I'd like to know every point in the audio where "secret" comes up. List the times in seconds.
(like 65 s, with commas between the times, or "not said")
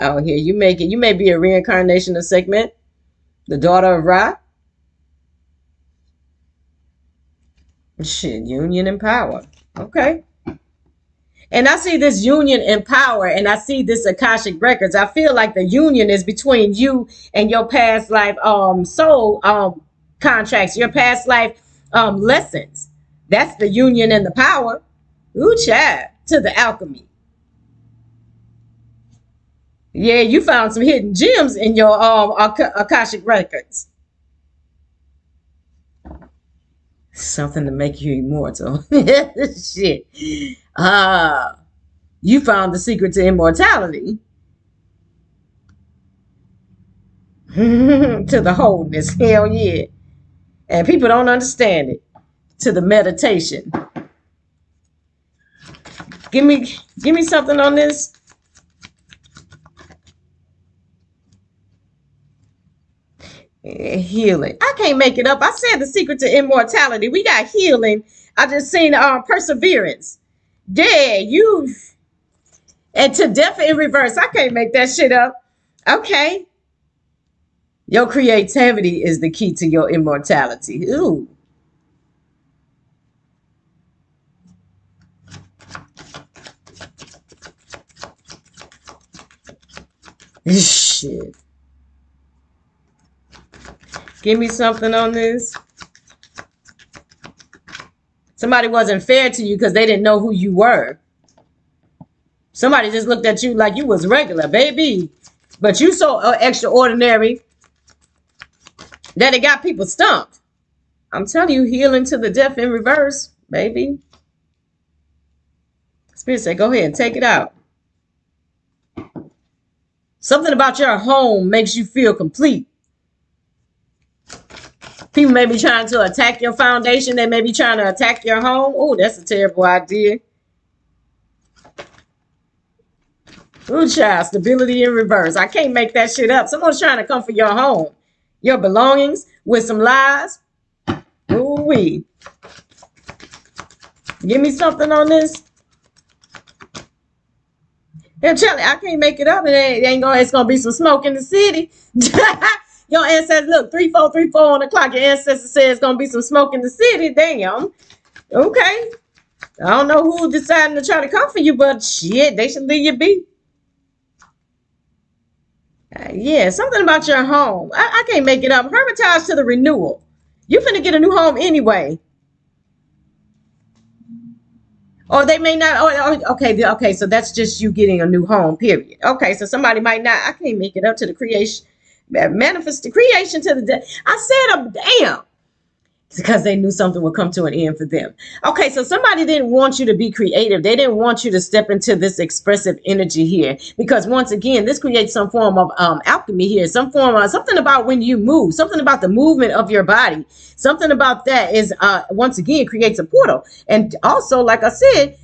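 42 s, 65 s.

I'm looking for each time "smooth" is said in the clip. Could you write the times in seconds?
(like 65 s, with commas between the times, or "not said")
not said.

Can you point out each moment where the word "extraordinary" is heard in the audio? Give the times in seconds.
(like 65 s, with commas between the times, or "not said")
106 s.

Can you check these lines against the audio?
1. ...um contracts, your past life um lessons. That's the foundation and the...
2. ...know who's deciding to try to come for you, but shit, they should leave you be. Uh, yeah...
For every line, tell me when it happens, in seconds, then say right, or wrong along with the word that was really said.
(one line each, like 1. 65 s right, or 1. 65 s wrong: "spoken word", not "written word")
1. 19 s wrong: "union", not "foundation"
2. 159 s right.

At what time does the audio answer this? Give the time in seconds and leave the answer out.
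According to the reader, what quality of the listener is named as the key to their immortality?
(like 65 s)
78 s.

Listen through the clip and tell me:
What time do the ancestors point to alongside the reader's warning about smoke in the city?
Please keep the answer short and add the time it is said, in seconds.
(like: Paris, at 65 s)
3:43, at 153 s.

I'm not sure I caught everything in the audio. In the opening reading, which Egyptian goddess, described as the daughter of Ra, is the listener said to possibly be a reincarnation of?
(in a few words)
Sekhmet.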